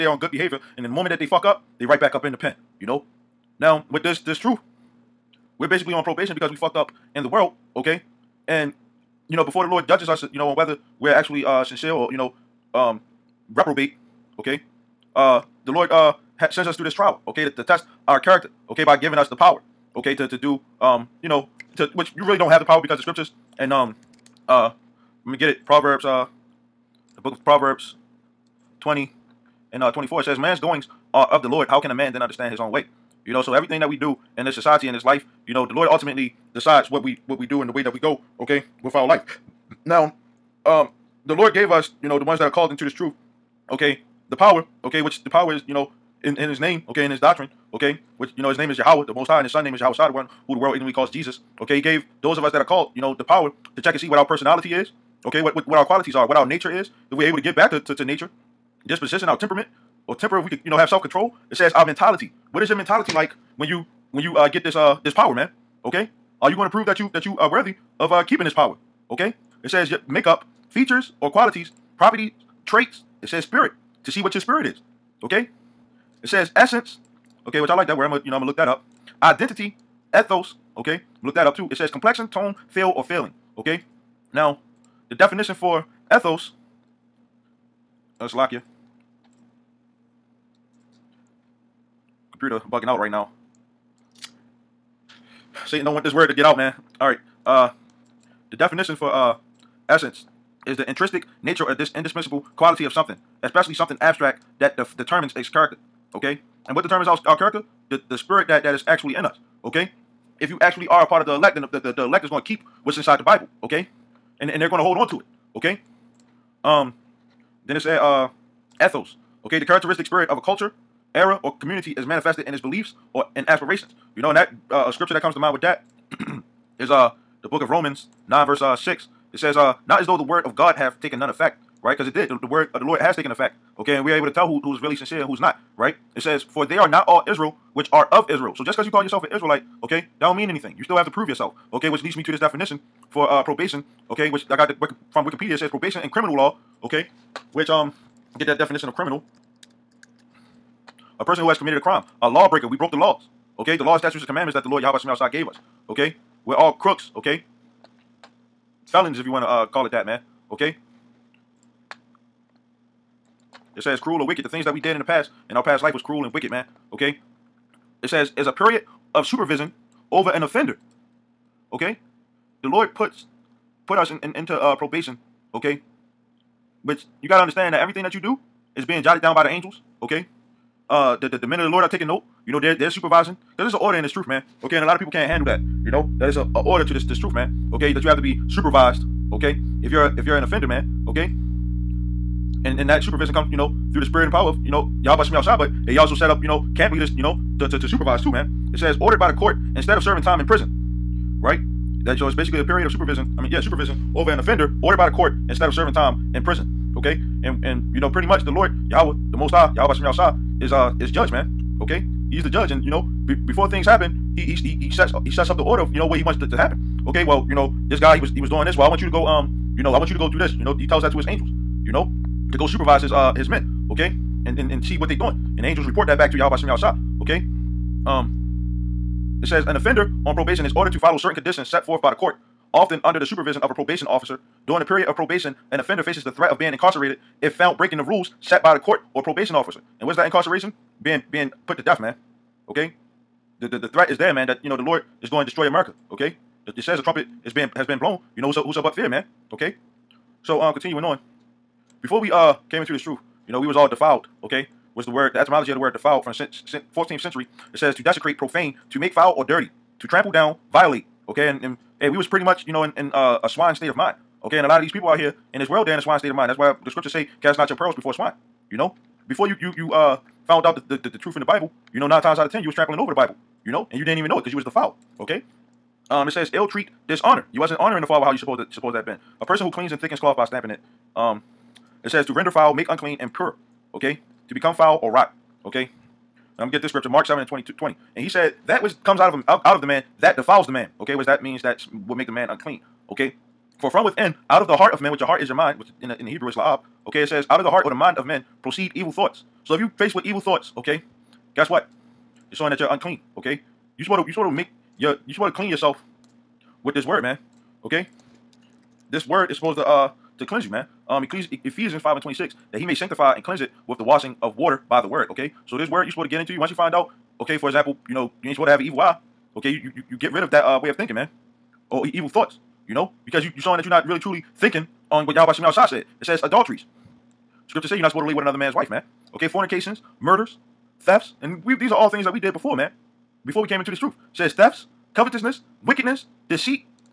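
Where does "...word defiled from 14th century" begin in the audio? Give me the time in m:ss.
4:15.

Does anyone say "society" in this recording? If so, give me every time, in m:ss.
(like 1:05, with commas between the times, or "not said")
0:34.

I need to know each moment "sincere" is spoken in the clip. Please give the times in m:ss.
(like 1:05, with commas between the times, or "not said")
0:11, 2:14.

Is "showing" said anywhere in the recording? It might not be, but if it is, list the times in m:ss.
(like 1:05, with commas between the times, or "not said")
5:02, 5:23.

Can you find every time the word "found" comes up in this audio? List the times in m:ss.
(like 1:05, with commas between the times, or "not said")
3:57, 4:30.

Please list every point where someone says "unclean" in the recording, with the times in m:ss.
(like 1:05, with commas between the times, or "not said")
4:42, 4:52, 5:02.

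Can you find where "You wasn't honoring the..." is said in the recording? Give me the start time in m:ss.
4:37.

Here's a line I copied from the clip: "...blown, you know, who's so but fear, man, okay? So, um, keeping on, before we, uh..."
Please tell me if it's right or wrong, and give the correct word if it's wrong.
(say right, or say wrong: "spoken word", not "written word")
wrong: "continuing", not "keeping".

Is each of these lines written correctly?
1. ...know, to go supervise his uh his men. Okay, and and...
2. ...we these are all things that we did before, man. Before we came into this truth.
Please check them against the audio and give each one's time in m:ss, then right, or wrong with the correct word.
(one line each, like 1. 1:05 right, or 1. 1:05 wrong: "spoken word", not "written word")
1. 3:41 right
2. 5:31 right.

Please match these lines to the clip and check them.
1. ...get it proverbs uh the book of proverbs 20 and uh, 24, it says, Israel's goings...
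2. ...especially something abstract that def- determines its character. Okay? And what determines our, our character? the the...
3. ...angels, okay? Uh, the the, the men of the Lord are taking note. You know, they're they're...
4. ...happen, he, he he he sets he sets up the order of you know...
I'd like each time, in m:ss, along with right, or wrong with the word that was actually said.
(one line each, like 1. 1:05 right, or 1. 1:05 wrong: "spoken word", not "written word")
1. 0:25 wrong: "Man", not "Israel"
2. 1:43 right
3. 2:59 right
4. 3:33 right.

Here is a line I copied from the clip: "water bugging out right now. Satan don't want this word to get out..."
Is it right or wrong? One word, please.
wrong.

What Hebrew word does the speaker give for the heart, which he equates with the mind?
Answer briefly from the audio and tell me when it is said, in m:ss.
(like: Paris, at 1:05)
laab, at 4:56.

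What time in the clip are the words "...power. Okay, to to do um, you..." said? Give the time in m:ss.
0:19.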